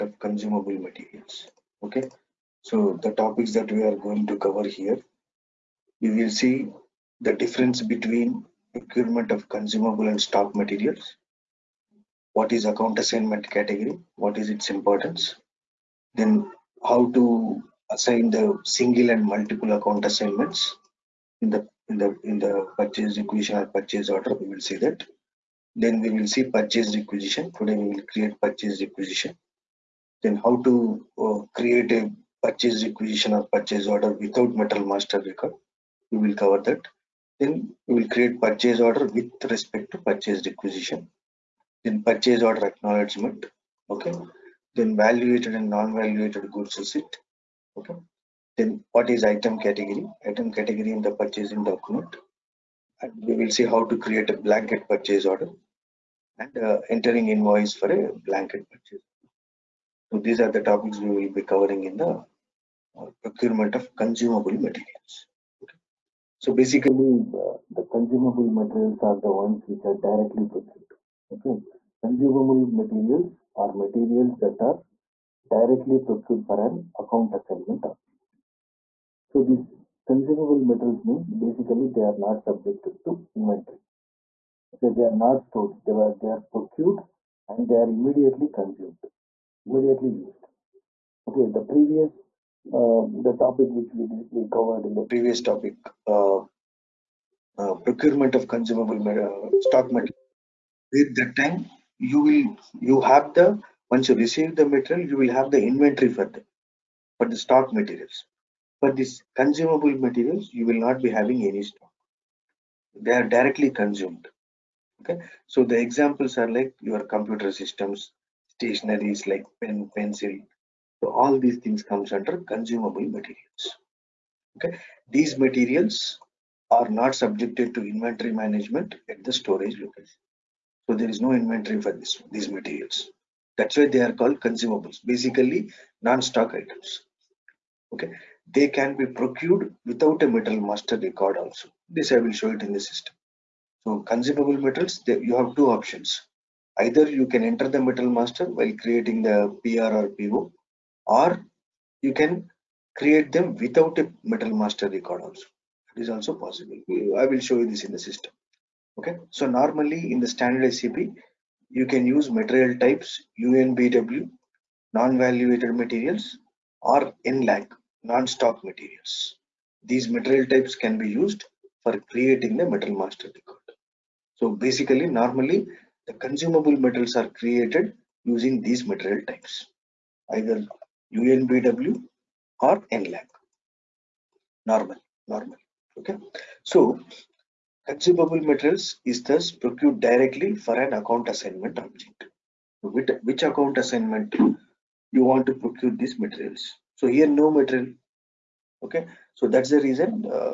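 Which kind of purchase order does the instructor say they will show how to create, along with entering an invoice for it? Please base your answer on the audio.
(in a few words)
Blanket purchase order.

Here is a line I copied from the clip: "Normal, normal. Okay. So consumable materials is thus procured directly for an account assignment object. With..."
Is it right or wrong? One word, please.
right.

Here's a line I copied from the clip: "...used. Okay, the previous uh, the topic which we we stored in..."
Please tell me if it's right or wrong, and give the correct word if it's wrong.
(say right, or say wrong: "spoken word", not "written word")
wrong: "covered", not "stored".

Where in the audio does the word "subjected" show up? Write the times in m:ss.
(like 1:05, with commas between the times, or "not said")
1:22, 2:07.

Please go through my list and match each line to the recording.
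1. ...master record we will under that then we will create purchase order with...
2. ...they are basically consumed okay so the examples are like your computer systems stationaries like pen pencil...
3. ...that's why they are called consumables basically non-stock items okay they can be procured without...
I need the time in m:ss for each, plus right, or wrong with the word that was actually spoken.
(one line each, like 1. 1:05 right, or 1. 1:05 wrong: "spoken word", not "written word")
1. 0:34 wrong: "cover", not "under"
2. 1:53 wrong: "directly", not "basically"
3. 2:13 right.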